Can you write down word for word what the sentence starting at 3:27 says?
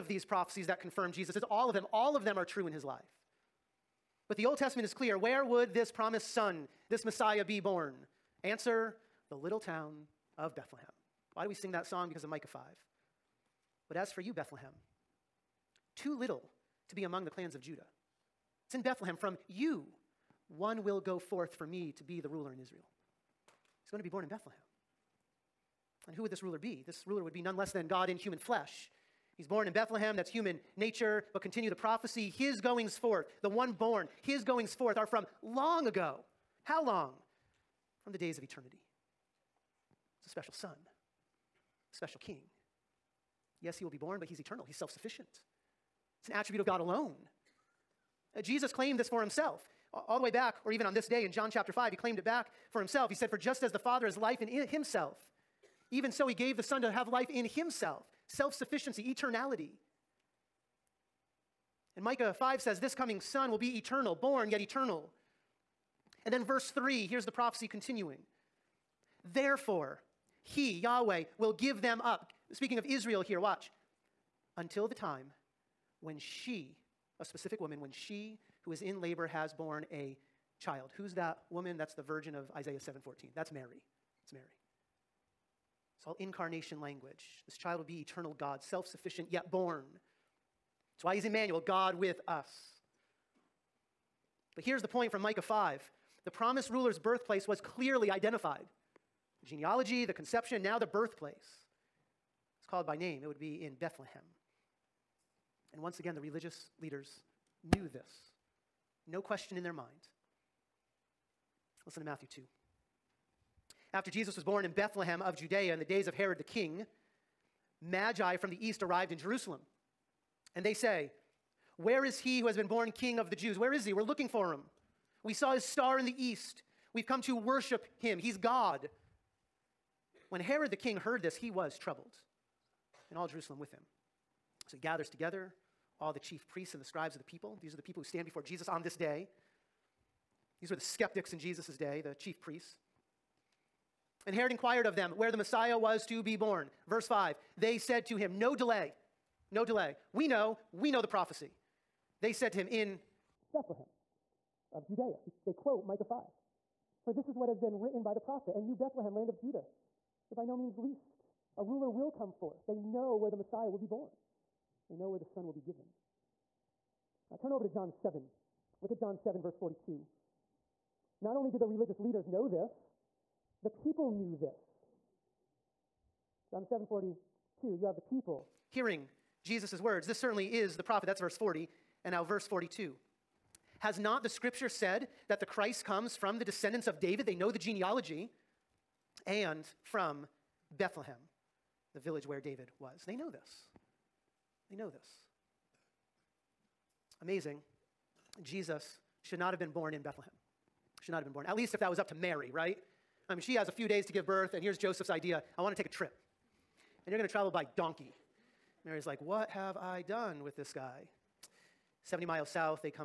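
And you're going to travel by donkey.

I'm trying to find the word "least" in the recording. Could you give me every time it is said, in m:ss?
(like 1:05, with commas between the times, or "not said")
2:40, 3:21.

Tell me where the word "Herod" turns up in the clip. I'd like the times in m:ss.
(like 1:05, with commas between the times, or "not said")
1:56, 2:10, 2:24.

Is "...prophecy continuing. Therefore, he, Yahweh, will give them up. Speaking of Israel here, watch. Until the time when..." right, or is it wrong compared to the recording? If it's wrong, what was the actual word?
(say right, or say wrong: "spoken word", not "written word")
right.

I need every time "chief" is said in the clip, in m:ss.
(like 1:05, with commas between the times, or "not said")
2:16, 2:22.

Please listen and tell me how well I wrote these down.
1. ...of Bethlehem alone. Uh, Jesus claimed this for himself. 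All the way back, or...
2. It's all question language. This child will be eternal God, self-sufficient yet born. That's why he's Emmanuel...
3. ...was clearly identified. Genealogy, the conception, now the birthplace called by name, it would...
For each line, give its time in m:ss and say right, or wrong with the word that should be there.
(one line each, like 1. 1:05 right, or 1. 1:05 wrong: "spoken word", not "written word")
1. 0:46 wrong: "God", not "Bethlehem"
2. 1:25 wrong: "incarnation", not "question"
3. 1:37 right.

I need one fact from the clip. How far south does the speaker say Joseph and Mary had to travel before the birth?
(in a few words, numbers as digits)
70 miles.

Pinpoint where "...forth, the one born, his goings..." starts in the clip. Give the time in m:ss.
0:32.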